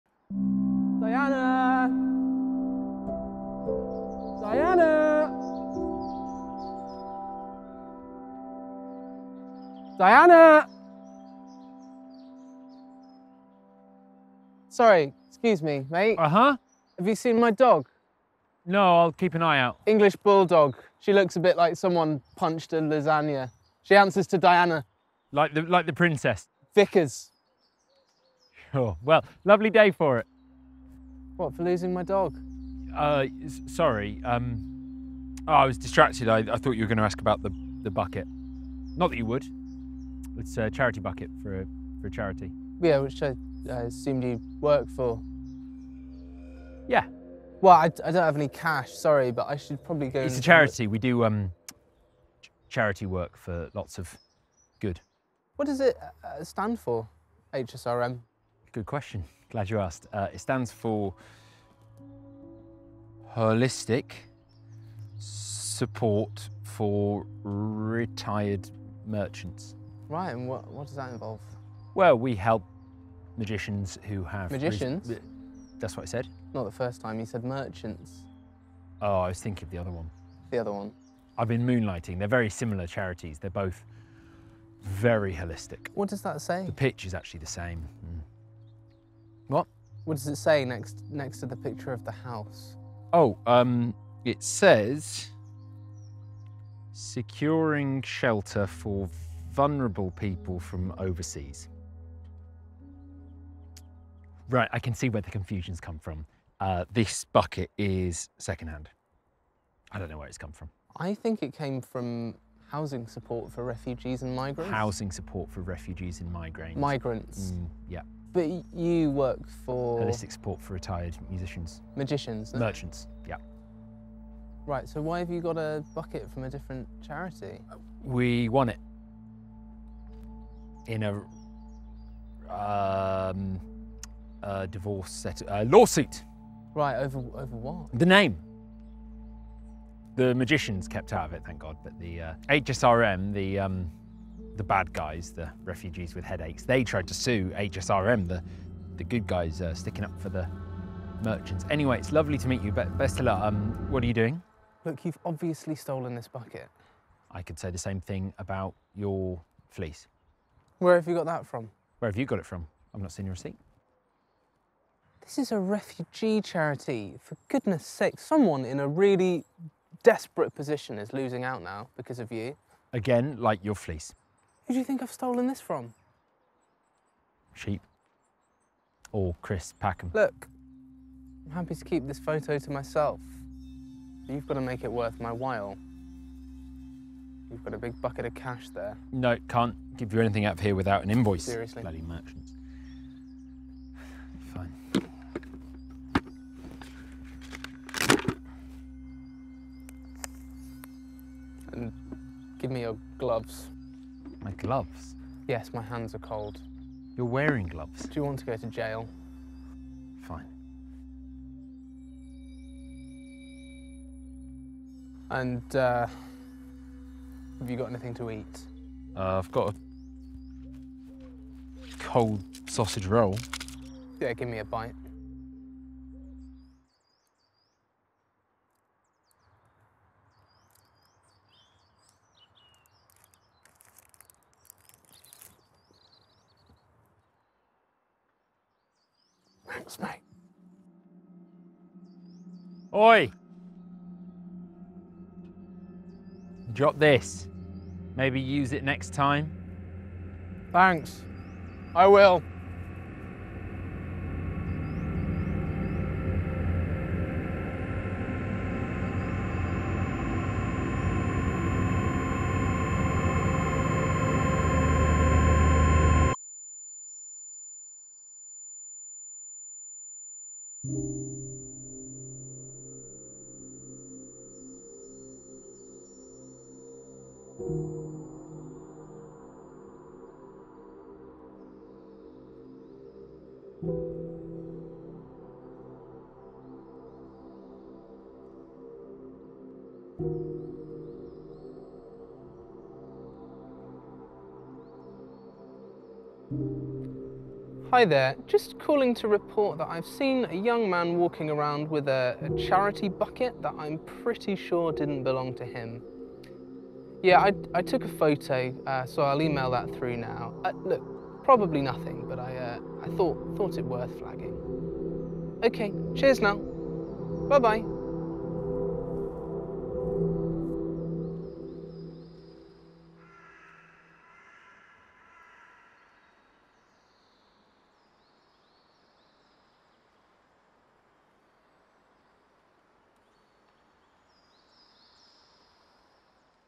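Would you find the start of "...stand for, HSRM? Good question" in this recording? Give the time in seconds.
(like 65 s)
56 s.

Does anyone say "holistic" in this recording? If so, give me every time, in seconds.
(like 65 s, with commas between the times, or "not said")
63 s, 85 s, 119 s.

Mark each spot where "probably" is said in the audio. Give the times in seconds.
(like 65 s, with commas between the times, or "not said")
49 s, 311 s.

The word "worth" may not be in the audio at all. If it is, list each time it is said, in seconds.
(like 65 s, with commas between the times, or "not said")
184 s, 313 s.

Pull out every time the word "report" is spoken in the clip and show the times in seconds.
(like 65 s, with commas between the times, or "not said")
299 s.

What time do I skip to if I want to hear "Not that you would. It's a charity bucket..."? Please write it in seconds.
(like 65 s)
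38 s.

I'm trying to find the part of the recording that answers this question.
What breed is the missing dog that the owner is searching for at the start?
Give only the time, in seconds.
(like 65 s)
19 s.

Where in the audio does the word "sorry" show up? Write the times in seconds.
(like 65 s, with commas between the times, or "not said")
14 s, 33 s, 48 s.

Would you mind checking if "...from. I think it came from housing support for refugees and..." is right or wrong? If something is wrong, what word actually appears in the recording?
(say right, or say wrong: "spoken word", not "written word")
right.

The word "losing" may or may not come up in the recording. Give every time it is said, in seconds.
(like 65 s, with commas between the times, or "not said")
31 s, 171 s.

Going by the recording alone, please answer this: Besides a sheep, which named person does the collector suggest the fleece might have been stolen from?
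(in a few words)
Chris Packham.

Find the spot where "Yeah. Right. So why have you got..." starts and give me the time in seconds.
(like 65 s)
123 s.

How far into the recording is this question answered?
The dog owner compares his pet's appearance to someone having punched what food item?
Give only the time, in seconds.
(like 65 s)
22 s.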